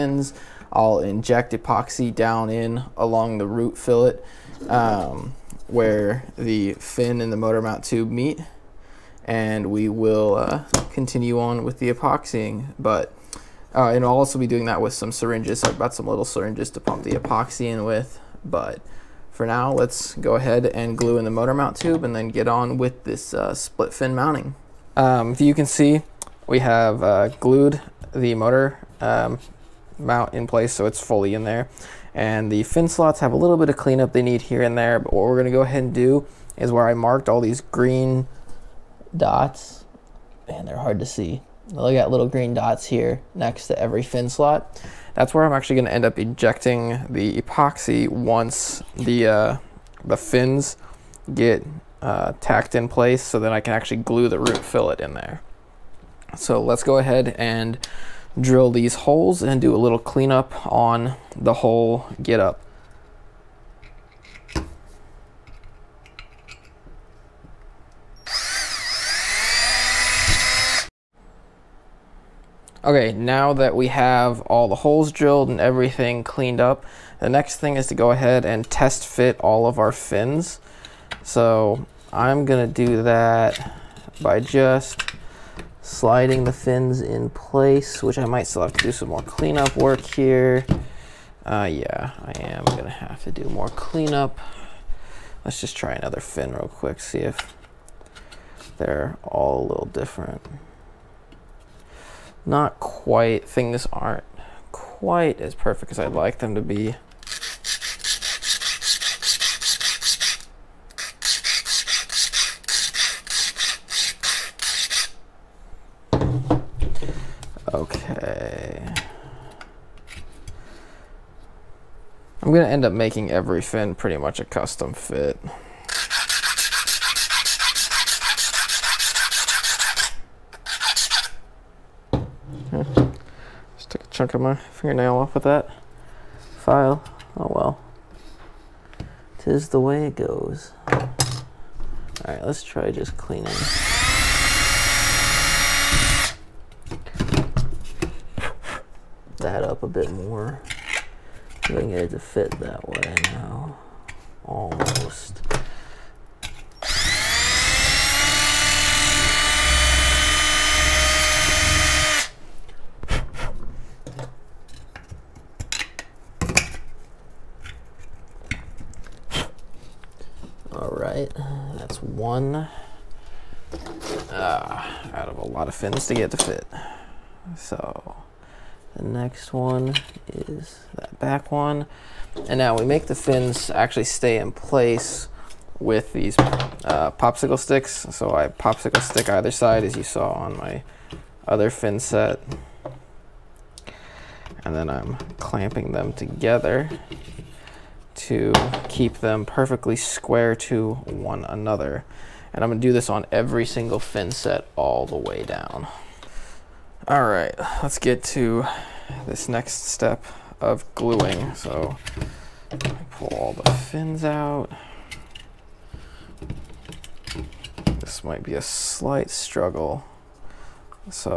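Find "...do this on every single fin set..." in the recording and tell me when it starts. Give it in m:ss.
3:22.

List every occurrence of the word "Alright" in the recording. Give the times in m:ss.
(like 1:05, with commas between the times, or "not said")
2:20, 2:50.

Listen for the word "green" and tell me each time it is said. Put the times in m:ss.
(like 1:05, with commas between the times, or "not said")
0:37, 0:42.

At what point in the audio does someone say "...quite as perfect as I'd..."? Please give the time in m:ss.
1:44.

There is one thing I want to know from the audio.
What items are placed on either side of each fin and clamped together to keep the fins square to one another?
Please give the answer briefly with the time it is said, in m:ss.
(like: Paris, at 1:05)
popsicle sticks, at 3:07.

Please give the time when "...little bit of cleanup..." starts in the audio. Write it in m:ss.
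0:33.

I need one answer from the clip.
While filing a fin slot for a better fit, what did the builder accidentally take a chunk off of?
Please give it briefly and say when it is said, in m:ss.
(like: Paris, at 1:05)
fingernail, at 2:14.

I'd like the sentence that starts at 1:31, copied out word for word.
Uh, yeah, I am gonna have to do more cleanup.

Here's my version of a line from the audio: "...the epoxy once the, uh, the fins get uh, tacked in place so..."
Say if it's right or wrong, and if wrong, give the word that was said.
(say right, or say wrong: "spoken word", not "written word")
right.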